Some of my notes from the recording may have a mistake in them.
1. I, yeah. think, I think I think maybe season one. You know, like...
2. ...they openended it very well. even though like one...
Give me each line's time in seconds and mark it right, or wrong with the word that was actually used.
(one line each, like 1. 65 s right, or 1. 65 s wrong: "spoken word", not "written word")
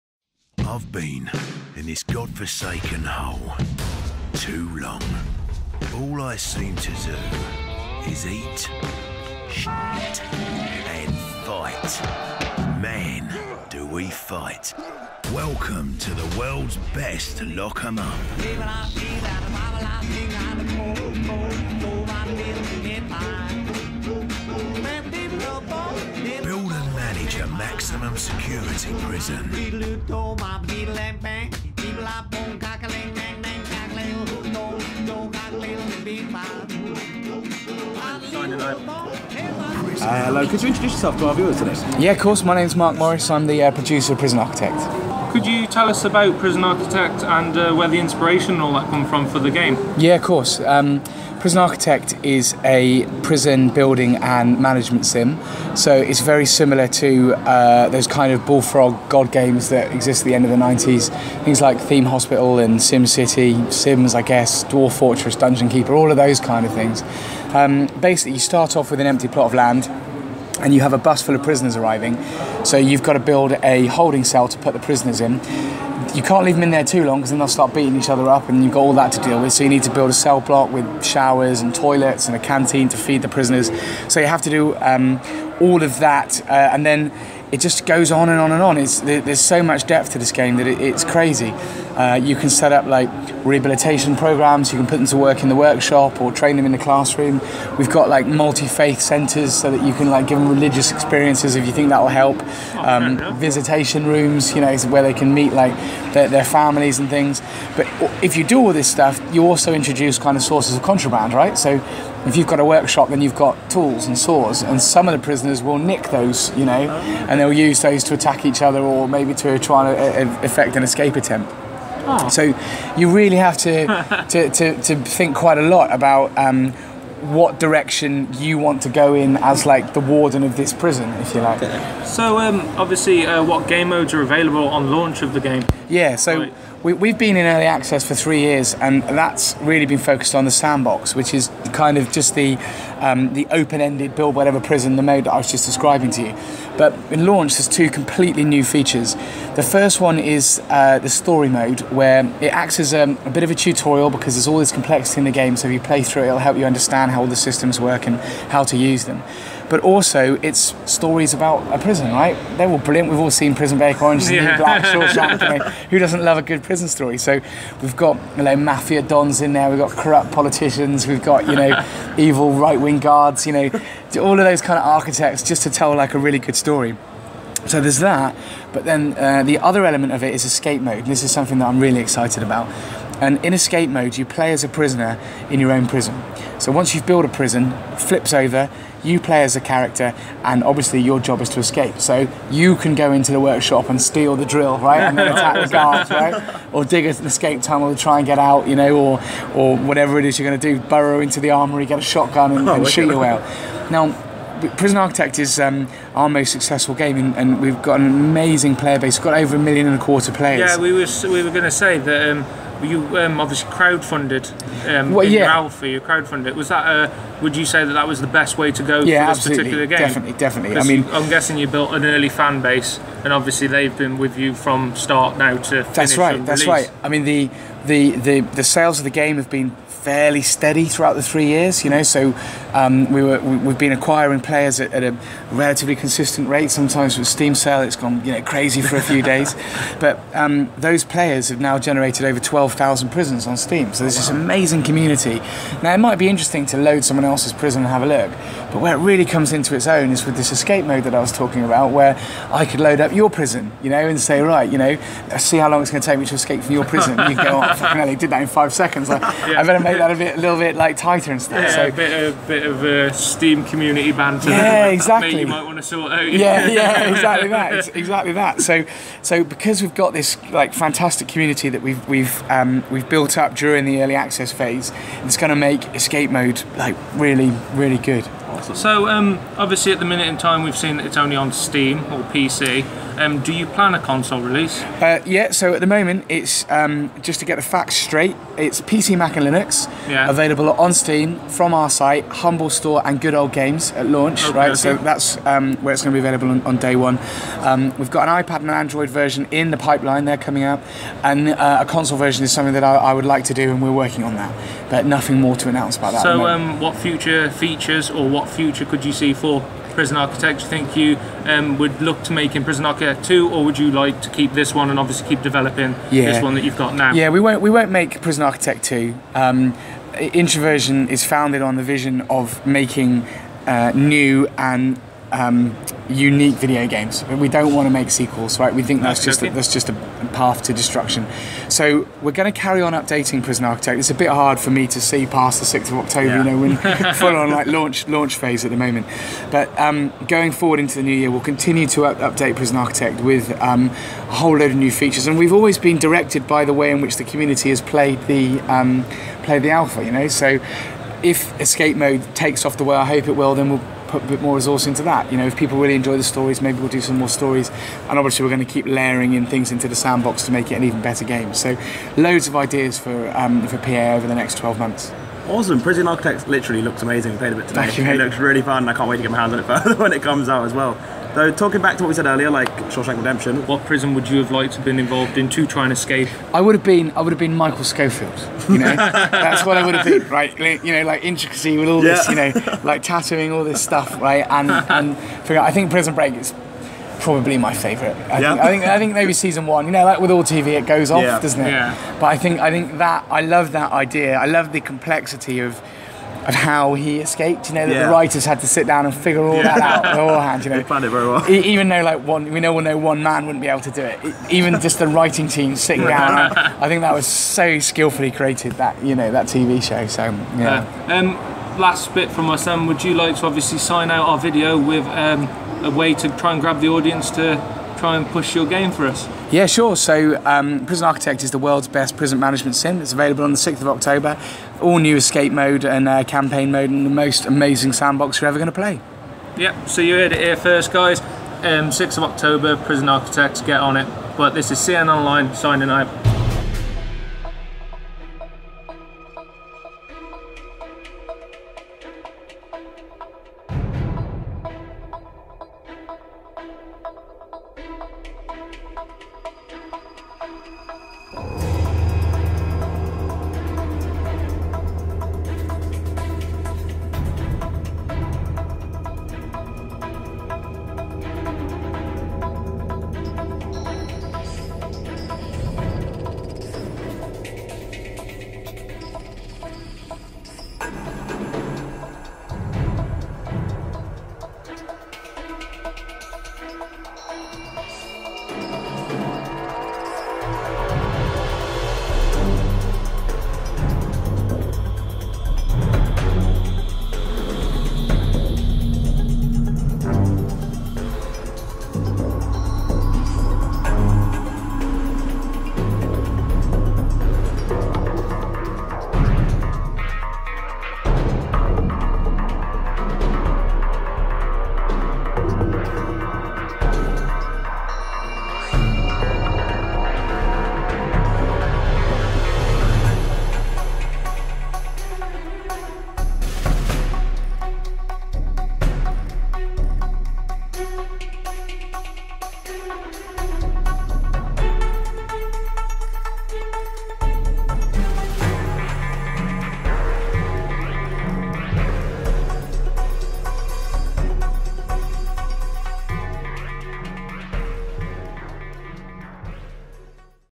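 1. 388 s right
2. 400 s wrong: "planned", not "openended".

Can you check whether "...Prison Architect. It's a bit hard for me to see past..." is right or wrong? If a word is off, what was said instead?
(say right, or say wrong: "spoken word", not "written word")
right.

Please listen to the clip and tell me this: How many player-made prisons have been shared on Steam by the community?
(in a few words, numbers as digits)
over 12,000.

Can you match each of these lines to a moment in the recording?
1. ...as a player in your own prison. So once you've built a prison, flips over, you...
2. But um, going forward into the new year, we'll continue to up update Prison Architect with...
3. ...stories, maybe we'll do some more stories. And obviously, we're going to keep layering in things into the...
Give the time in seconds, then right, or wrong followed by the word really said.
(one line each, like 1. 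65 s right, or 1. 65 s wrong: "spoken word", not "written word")
1. 184 s wrong: "prisoner", not "player"
2. 339 s right
3. 356 s right.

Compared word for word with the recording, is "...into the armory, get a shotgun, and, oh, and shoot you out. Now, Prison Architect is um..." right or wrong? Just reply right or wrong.
right.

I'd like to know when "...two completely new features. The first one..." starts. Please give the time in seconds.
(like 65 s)
147 s.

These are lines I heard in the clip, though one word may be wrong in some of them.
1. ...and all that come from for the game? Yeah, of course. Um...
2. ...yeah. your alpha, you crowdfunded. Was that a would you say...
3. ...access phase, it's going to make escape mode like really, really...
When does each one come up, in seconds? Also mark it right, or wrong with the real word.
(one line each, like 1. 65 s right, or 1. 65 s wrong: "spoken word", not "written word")
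1. 48 s right
2. 215 s right
3. 274 s right.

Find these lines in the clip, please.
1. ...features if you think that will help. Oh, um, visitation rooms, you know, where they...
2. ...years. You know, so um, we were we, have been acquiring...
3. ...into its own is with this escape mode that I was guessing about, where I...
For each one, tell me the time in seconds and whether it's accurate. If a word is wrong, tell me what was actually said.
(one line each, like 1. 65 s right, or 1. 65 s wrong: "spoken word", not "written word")
1. 100 s wrong: "experiences", not "features"
2. 231 s right
3. 249 s wrong: "talking", not "guessing".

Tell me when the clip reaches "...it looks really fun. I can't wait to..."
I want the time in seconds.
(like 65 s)
368 s.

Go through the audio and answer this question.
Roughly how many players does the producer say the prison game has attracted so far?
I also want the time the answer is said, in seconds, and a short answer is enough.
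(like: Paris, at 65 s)
over 1.25 million, at 209 s.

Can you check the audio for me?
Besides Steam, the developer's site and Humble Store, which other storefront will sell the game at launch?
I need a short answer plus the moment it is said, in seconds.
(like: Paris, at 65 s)
Good Old Games, at 293 s.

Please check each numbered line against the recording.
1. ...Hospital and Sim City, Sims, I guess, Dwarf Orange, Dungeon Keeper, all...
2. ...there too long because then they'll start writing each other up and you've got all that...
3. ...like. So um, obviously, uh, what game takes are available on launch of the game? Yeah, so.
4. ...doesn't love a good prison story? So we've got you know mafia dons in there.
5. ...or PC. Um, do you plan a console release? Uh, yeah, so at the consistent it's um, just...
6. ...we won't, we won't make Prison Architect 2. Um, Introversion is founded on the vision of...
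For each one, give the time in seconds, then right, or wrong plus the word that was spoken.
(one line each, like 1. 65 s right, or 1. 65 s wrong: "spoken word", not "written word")
1. 62 s wrong: "Fortress", not "Orange"
2. 76 s wrong: "beating", not "writing"
3. 131 s wrong: "modes", not "takes"
4. 165 s right
5. 282 s wrong: "moment", not "consistent"
6. 317 s right.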